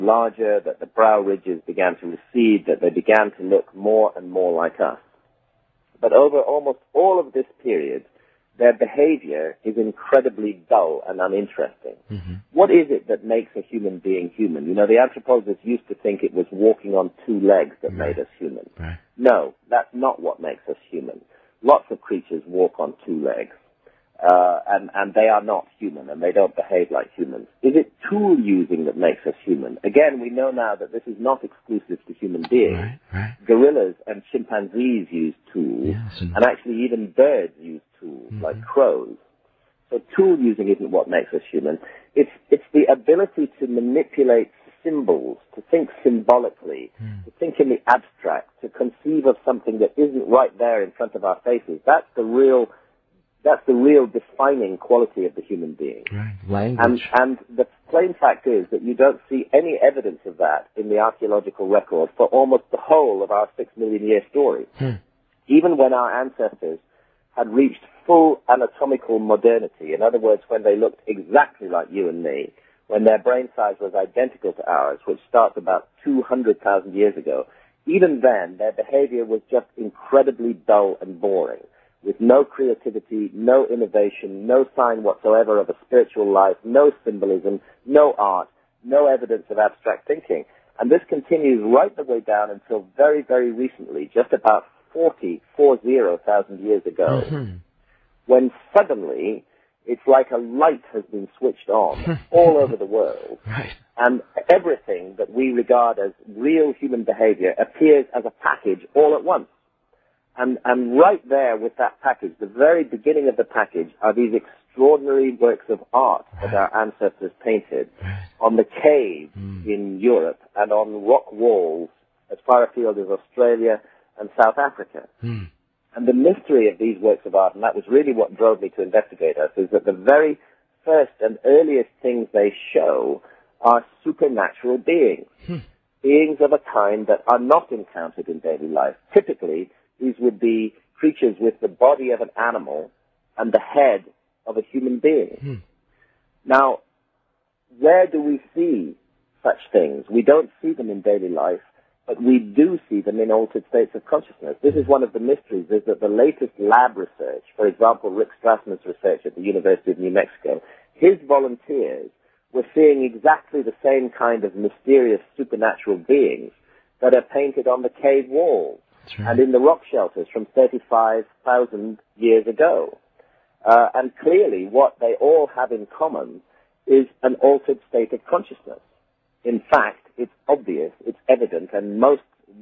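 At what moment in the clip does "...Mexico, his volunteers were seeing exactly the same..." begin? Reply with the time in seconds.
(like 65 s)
160 s.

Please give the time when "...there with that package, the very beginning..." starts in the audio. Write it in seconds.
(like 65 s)
111 s.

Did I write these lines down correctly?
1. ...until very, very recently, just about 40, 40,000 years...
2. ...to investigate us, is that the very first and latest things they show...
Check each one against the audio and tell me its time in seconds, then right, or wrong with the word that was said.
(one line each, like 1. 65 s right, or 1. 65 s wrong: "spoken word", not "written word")
1. 92 s right
2. 128 s wrong: "earliest", not "latest".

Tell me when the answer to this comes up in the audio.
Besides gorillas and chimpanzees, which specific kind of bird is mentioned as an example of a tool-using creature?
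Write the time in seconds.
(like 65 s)
38 s.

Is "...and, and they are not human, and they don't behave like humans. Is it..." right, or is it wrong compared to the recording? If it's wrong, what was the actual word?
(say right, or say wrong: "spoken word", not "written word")
right.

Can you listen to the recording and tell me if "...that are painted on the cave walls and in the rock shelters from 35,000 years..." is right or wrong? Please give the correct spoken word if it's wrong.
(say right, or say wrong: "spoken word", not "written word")
right.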